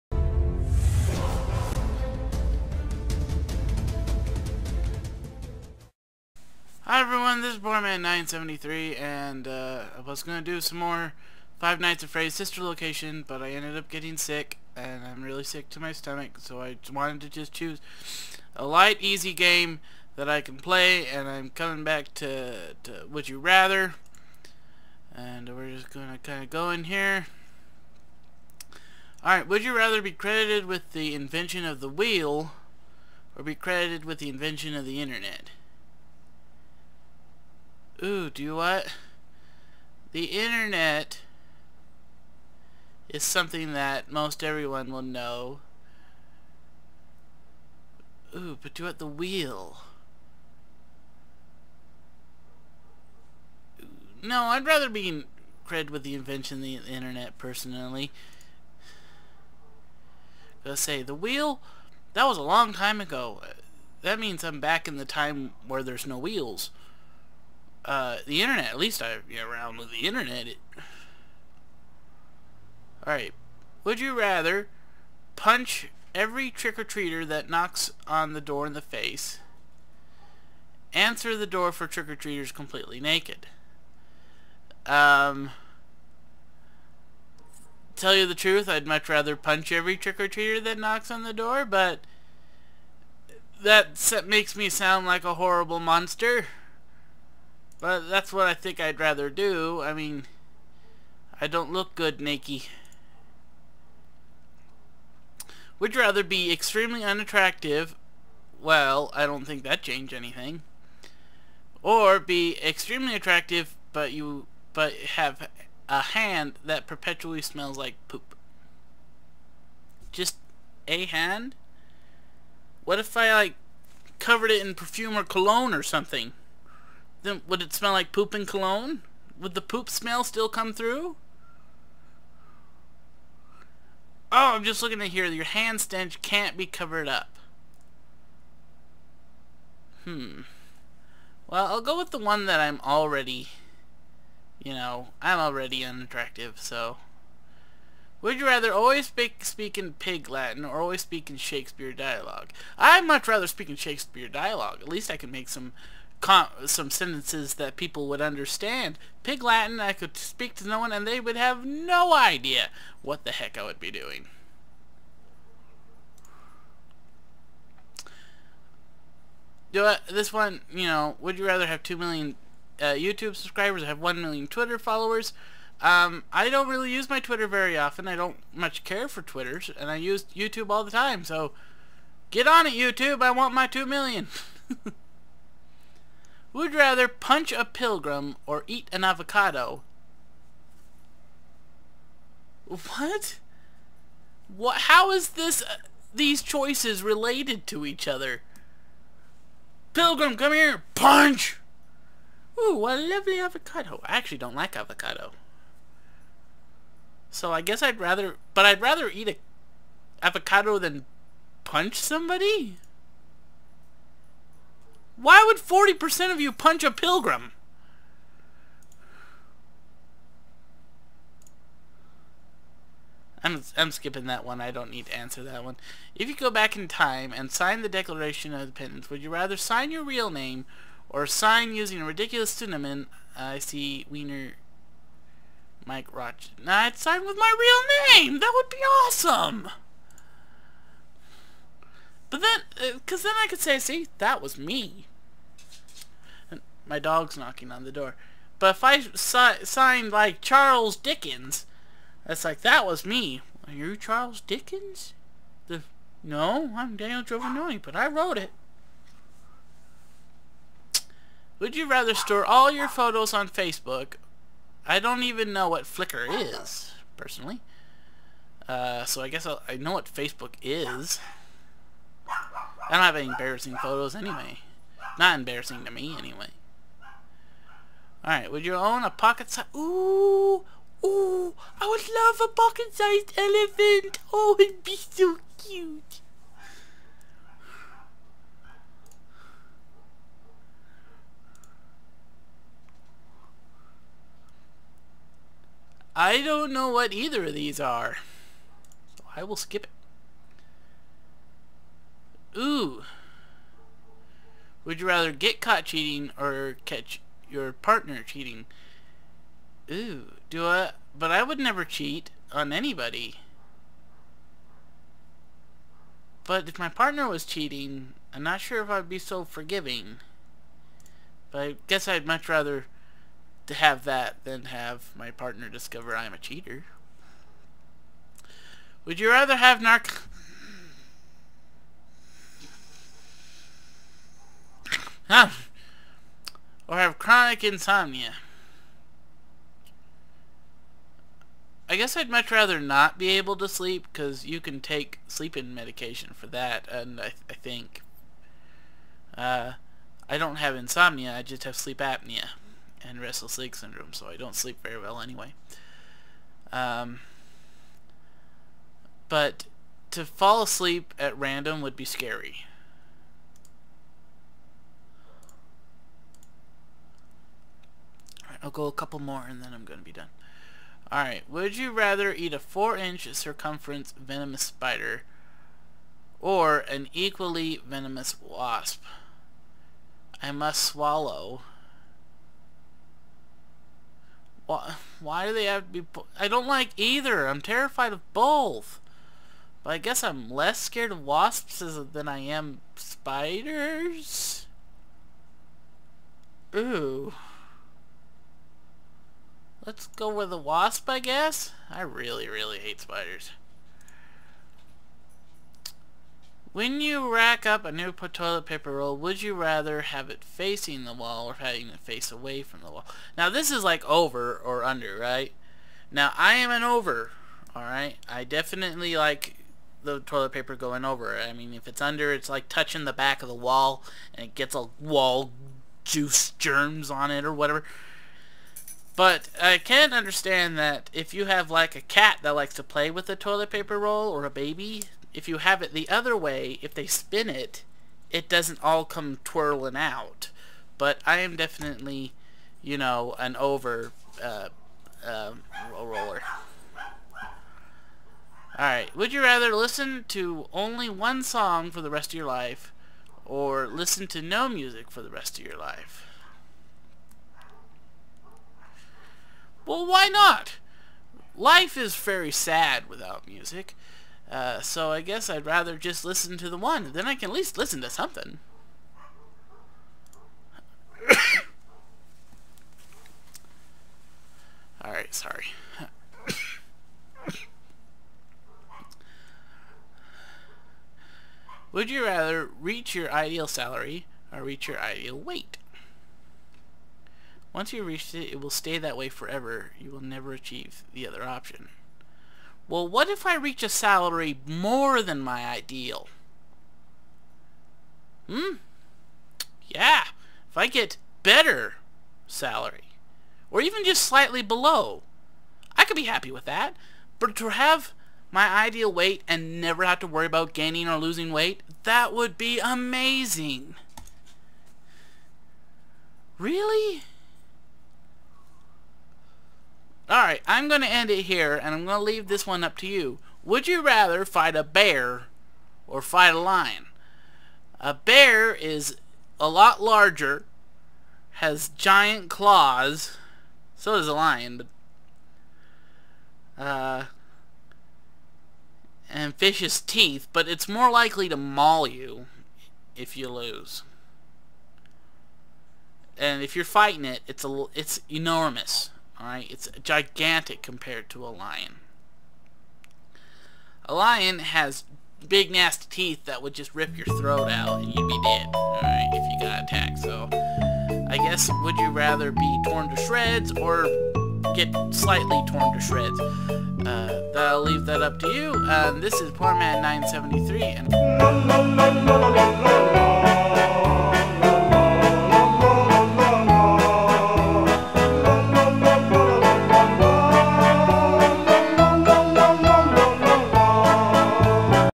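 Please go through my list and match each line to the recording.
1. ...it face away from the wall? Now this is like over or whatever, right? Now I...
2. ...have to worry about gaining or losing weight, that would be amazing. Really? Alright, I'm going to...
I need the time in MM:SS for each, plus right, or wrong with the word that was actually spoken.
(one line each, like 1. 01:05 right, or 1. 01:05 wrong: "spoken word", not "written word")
1. 06:51 wrong: "under", not "whatever"
2. 08:30 right.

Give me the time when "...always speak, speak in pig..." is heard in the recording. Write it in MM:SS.
02:28.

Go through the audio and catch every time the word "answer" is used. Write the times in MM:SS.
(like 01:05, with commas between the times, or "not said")
01:20, 03:45.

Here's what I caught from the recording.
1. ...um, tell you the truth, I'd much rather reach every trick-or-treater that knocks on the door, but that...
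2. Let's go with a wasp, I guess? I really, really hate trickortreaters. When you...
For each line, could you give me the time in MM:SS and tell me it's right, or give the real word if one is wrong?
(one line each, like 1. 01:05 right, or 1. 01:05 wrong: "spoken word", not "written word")
1. 01:24 wrong: "punch", not "reach"
2. 06:39 wrong: "spiders", not "trickortreaters".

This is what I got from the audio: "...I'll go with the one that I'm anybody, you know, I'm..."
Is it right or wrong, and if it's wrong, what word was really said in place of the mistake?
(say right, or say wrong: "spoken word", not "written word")
wrong: "already", not "anybody".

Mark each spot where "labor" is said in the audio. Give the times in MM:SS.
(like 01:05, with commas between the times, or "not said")
not said.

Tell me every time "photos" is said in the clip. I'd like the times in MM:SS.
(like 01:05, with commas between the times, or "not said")
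04:22, 04:33.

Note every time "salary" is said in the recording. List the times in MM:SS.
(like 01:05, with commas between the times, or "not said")
08:03, 08:13, 08:22.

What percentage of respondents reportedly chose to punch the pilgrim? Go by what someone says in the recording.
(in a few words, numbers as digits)
40%.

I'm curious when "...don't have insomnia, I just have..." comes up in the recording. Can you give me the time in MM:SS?
05:50.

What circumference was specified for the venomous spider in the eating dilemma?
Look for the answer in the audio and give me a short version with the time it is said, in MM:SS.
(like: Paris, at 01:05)
4 inches, at 06:12.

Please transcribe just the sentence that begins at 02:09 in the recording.
Would the poop smell still come through?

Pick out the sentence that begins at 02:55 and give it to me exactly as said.
Um, I don't really use my Twitter very often.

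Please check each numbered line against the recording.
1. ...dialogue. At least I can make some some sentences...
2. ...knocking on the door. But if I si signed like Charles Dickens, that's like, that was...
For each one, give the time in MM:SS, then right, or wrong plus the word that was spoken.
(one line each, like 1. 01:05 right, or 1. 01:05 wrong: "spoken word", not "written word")
1. 02:34 right
2. 04:07 right.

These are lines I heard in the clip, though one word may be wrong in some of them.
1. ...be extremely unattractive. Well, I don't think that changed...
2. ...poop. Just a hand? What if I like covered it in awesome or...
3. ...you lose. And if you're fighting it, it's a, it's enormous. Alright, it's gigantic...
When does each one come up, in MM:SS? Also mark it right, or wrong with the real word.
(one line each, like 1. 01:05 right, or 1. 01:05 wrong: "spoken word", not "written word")
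1. 01:46 right
2. 01:58 wrong: "perfume", not "awesome"
3. 09:03 right.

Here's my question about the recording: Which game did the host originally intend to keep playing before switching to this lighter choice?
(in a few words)
Five Nights at Freddy's Sister Location.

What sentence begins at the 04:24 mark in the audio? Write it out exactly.
I don't even know what Flickr is, personally.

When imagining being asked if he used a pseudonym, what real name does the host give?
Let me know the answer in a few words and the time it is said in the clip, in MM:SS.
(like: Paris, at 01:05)
Daniel Giovanni, at 04:16.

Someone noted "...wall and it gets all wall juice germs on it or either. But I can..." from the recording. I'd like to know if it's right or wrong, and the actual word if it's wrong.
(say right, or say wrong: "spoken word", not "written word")
wrong: "whatever", not "either".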